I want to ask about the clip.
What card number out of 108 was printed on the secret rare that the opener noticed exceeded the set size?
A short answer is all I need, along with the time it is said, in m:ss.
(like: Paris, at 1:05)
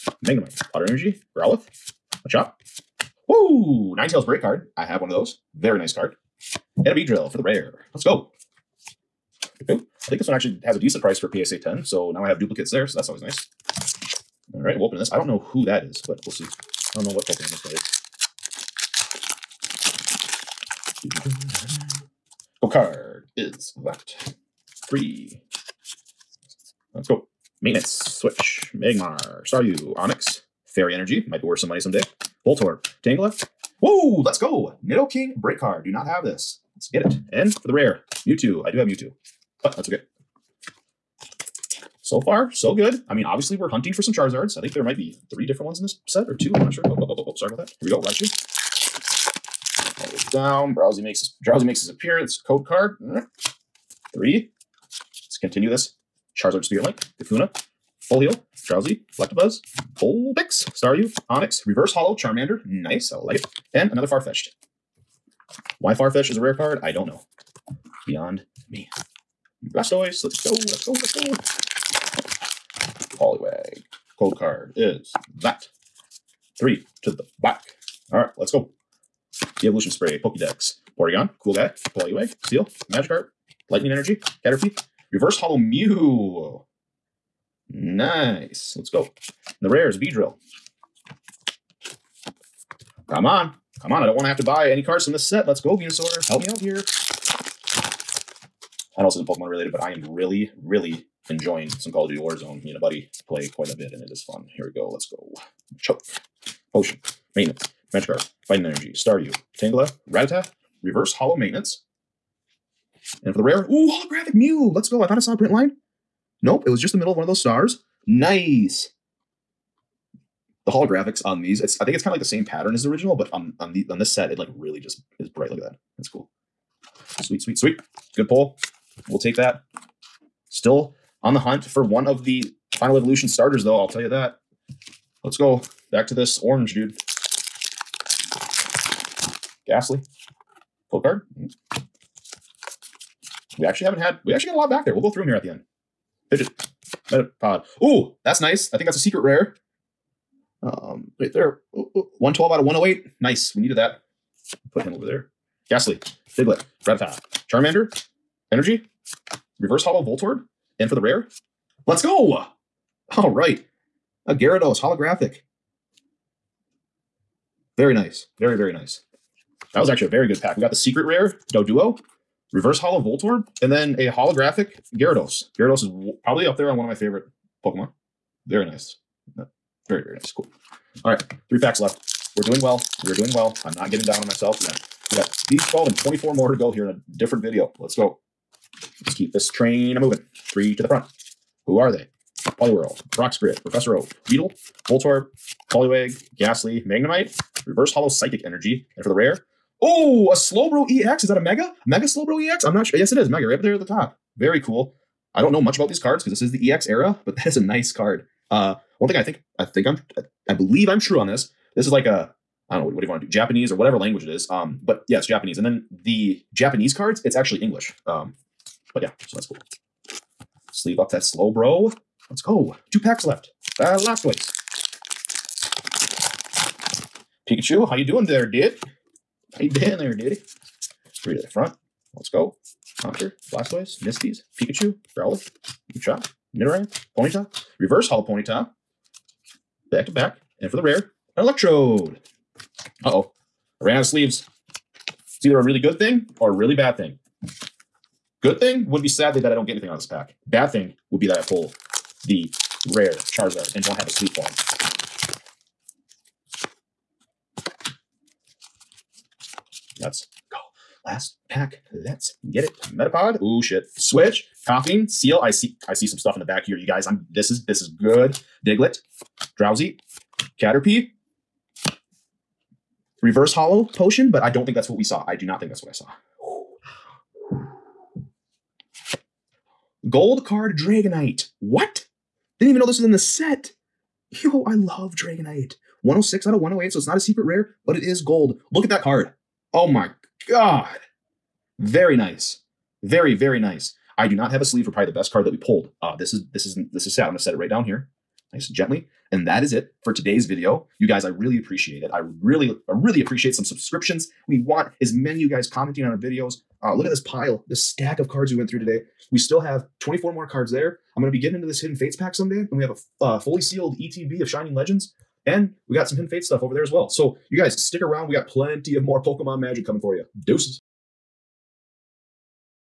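112, at 2:31.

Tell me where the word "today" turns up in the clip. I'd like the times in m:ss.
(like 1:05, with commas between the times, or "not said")
5:00, 5:08.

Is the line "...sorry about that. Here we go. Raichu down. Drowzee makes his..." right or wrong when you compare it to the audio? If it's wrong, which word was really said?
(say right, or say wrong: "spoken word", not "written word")
right.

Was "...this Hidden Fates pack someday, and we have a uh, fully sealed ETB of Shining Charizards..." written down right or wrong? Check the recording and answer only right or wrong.
wrong.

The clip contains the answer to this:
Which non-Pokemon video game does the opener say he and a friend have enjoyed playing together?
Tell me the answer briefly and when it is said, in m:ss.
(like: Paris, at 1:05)
Call of Duty Warzone, at 1:41.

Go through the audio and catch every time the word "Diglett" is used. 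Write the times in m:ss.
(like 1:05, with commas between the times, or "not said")
2:36, 4:28.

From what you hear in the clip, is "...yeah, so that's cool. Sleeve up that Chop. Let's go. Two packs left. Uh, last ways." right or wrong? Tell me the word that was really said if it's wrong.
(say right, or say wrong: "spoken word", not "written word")
wrong: "Slowbro", not "Chop".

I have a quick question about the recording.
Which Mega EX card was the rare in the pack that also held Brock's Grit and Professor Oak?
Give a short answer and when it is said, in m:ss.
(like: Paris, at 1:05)
Mega Slowbro EX, at 3:21.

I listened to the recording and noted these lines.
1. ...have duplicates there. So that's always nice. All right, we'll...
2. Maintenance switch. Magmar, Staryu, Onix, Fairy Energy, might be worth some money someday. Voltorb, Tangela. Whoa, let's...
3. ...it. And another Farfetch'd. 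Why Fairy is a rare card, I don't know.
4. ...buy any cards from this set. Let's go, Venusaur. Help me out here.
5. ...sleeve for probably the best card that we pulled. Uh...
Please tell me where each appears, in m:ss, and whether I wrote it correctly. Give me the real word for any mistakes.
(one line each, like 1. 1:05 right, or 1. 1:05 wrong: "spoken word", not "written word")
1. 0:12 right
2. 0:27 right
3. 1:03 wrong: "Farfetch", not "Fairy"
4. 1:34 right
5. 4:54 right.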